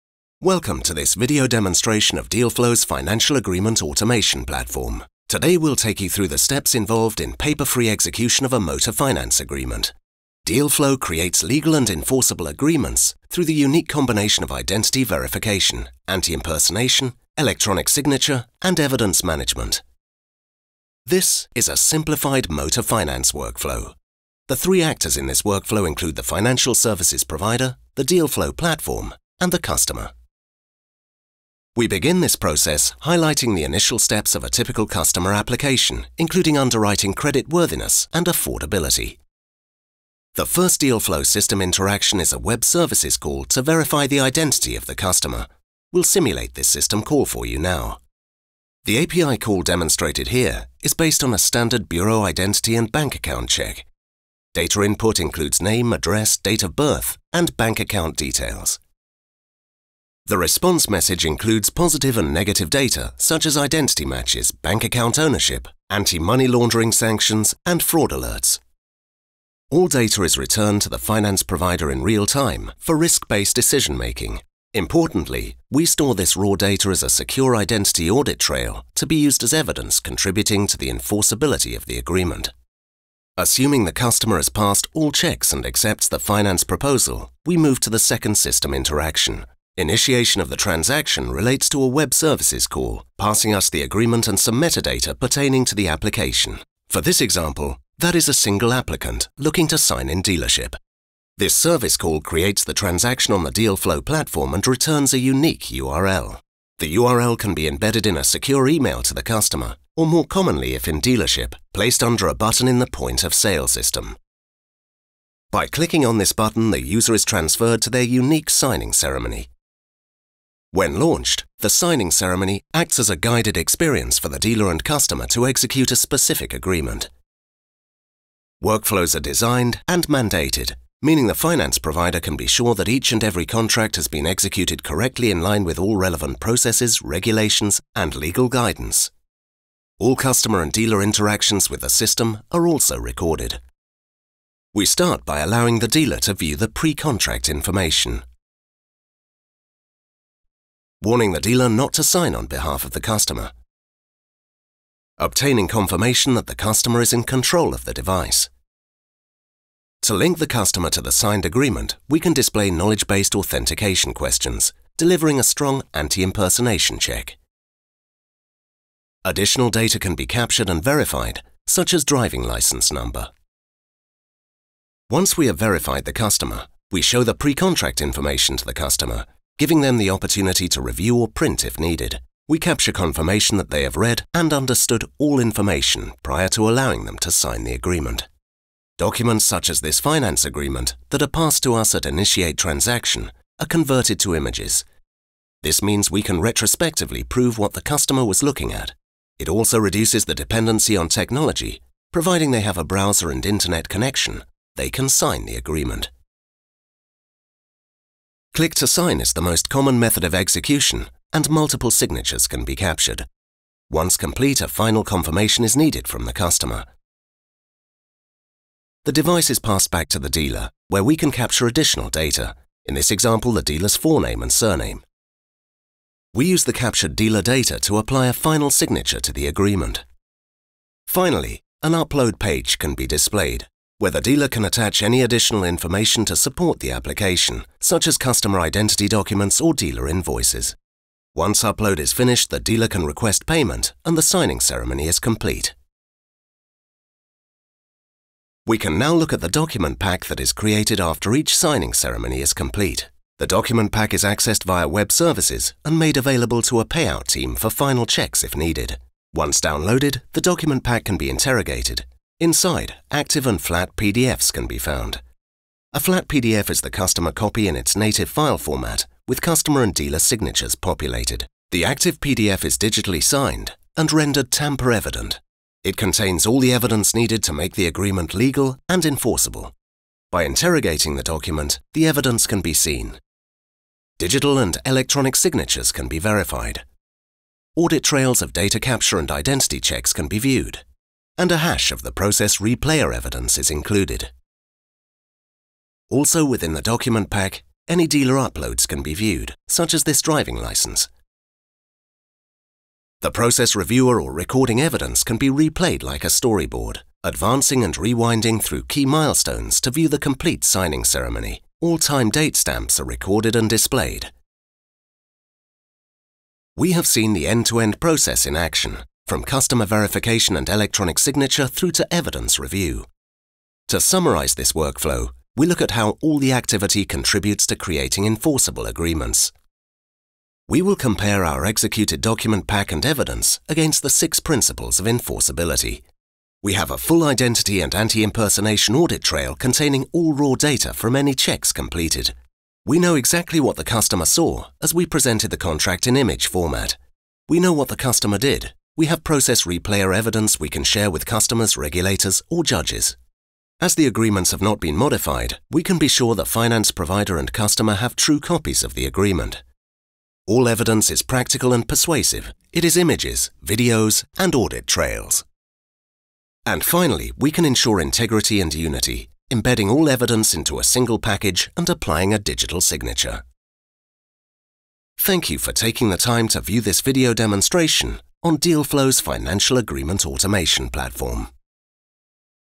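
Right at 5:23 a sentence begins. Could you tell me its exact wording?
To summarize this workflow, we look at how all the activity contributes to creating enforceable agreements.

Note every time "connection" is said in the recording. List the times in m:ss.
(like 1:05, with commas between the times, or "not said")
3:23.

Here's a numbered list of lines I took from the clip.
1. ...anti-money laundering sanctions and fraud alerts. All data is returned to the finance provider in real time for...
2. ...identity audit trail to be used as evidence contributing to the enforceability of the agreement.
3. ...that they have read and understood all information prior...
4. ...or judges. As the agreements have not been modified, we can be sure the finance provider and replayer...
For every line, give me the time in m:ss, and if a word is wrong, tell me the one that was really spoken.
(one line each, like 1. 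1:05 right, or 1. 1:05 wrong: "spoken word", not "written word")
1. 1:05 right
2. 1:17 right
3. 3:03 right
4. 5:52 wrong: "customer", not "replayer".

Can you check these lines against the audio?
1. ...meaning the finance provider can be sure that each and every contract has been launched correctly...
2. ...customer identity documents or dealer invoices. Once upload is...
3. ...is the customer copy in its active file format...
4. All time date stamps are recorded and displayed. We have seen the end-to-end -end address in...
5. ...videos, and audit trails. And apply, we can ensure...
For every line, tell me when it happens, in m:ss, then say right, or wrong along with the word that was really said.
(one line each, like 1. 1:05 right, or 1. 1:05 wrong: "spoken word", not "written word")
1. 2:11 wrong: "executed", not "launched"
2. 3:58 right
3. 4:26 wrong: "native", not "active"
4. 5:11 wrong: "process", not "address"
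5. 6:03 wrong: "finally", not "apply".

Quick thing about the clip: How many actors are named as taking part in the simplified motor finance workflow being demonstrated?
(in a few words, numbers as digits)
3.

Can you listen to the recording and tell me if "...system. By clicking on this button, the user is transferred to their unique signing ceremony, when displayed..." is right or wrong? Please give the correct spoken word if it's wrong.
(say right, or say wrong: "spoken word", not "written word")
wrong: "launched", not "displayed".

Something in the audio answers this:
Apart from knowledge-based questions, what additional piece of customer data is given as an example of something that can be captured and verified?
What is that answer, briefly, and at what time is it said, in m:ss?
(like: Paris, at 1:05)
Driving license number, at 2:52.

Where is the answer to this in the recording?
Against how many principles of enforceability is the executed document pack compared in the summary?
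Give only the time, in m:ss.
5:34.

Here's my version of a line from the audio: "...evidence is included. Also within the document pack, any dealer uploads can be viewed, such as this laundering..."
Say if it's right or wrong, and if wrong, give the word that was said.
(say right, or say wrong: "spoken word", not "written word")
wrong: "driving", not "laundering".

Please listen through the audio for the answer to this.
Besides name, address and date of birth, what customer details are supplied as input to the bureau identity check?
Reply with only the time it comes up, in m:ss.
0:57.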